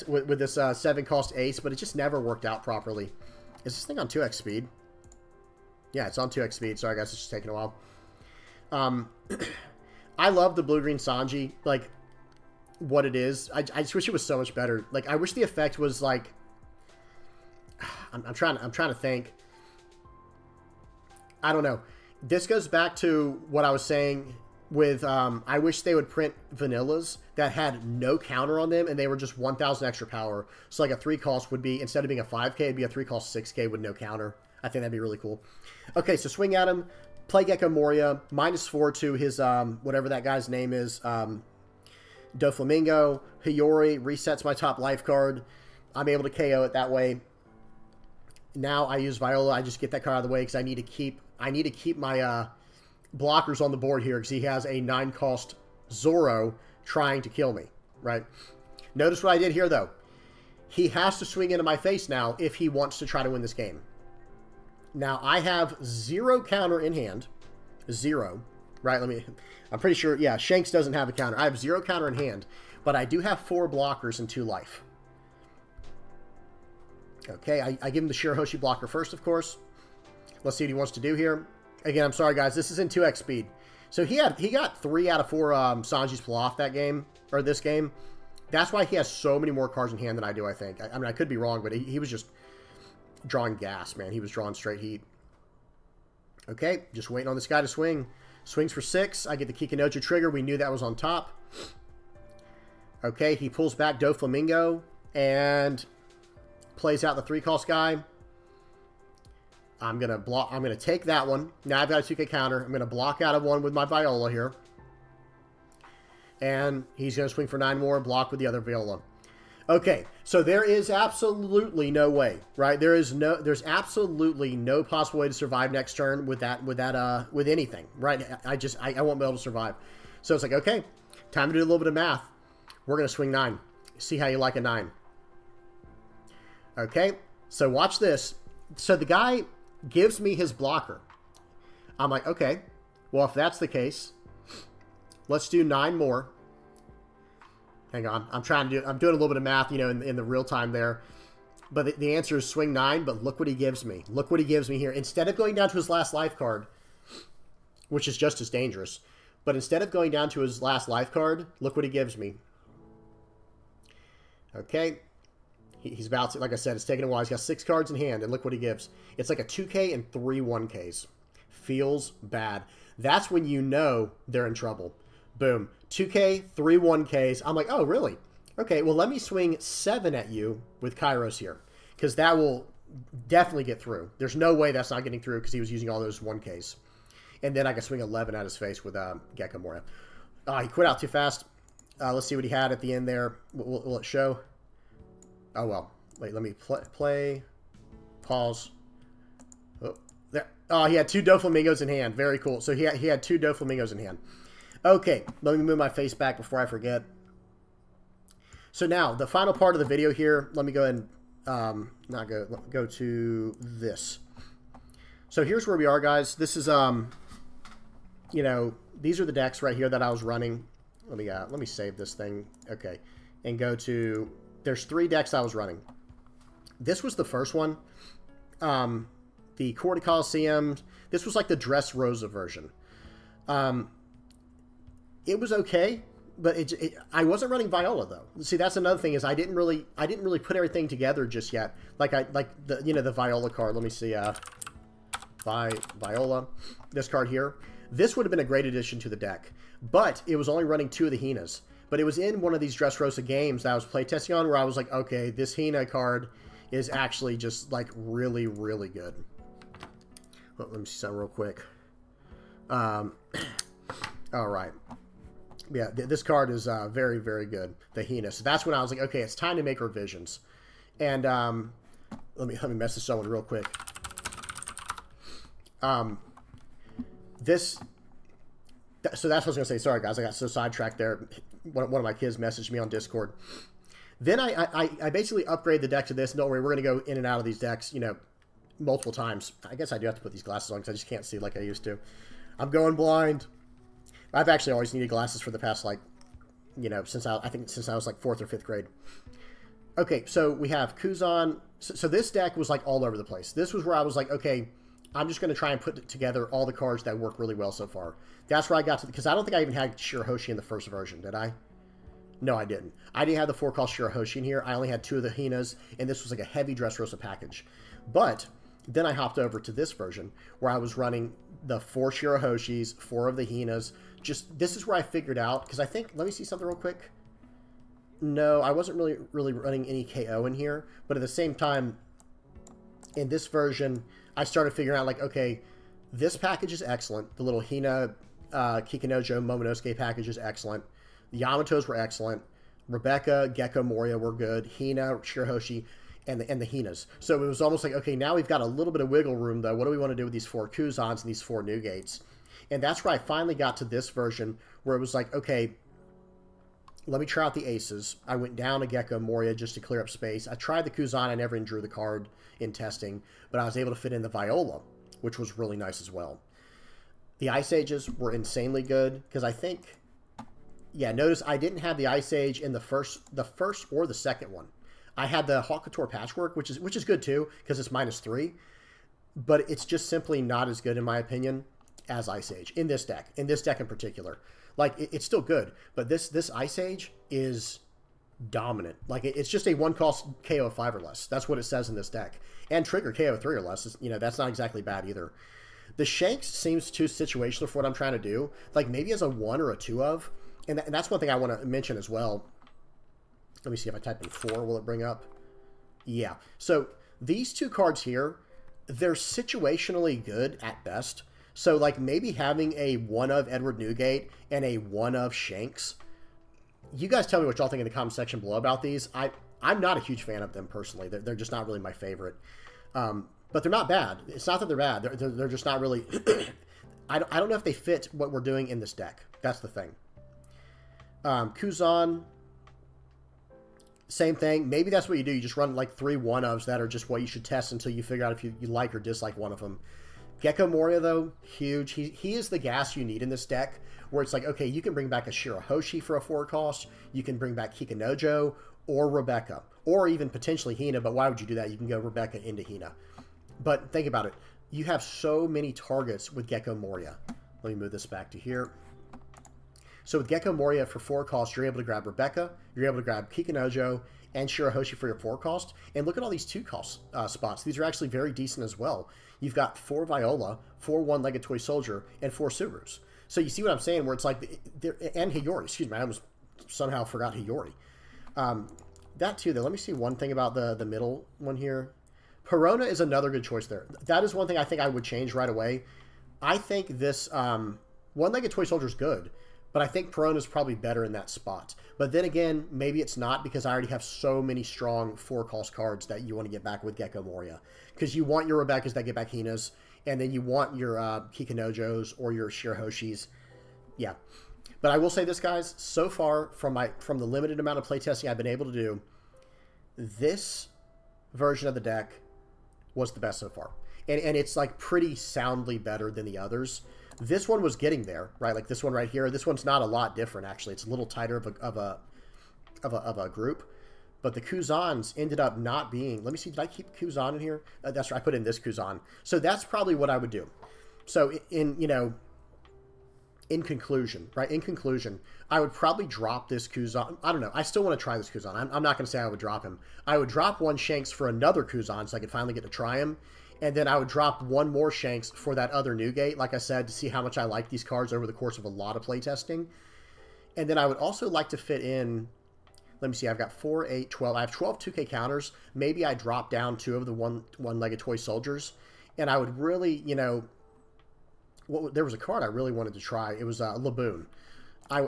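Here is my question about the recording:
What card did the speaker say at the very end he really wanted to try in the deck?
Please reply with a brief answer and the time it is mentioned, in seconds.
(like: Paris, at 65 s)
Laboon, at 563 s.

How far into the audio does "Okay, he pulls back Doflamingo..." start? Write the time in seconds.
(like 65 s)
103 s.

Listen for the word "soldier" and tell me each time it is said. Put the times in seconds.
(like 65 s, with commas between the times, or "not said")
471 s, 488 s, 558 s.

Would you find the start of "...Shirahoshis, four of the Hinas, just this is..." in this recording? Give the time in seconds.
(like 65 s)
322 s.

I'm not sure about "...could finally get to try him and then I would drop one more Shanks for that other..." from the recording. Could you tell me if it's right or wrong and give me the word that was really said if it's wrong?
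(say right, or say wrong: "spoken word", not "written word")
right.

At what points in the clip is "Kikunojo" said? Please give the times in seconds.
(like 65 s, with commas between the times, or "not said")
99 s, 338 s, 447 s, 463 s, 501 s.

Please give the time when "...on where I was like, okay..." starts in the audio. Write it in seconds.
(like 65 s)
254 s.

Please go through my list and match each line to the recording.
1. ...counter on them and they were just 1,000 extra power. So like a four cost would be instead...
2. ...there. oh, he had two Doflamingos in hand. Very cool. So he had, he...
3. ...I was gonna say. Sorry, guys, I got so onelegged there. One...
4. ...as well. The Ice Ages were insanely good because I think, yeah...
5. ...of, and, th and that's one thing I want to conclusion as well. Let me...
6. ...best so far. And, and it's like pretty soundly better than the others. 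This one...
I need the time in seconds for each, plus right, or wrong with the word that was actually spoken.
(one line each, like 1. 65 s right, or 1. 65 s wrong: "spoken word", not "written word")
1. 28 s wrong: "three", not "four"
2. 200 s right
3. 279 s wrong: "sidetracked", not "onelegged"
4. 366 s right
5. 400 s wrong: "mention", not "conclusion"
6. 513 s right.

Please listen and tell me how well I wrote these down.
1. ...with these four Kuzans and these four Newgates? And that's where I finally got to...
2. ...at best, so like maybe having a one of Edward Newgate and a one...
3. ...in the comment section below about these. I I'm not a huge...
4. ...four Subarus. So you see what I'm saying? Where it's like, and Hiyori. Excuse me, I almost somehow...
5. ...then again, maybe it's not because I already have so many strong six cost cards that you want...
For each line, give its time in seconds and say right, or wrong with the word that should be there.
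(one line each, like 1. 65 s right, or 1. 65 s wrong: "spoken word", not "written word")
1. 350 s right
2. 410 s right
3. 417 s right
4. 472 s right
5. 492 s wrong: "four", not "six".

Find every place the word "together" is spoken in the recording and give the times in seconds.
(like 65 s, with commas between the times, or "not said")
240 s, 306 s.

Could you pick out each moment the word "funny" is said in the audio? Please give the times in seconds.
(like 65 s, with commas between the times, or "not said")
not said.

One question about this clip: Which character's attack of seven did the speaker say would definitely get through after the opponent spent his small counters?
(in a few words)
Kyros.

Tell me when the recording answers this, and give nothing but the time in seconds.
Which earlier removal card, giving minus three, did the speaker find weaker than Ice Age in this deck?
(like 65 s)
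375 s.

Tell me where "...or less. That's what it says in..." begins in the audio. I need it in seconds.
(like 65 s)
390 s.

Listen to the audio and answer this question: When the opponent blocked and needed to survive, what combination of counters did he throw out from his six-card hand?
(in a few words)
2K and three 1Ks.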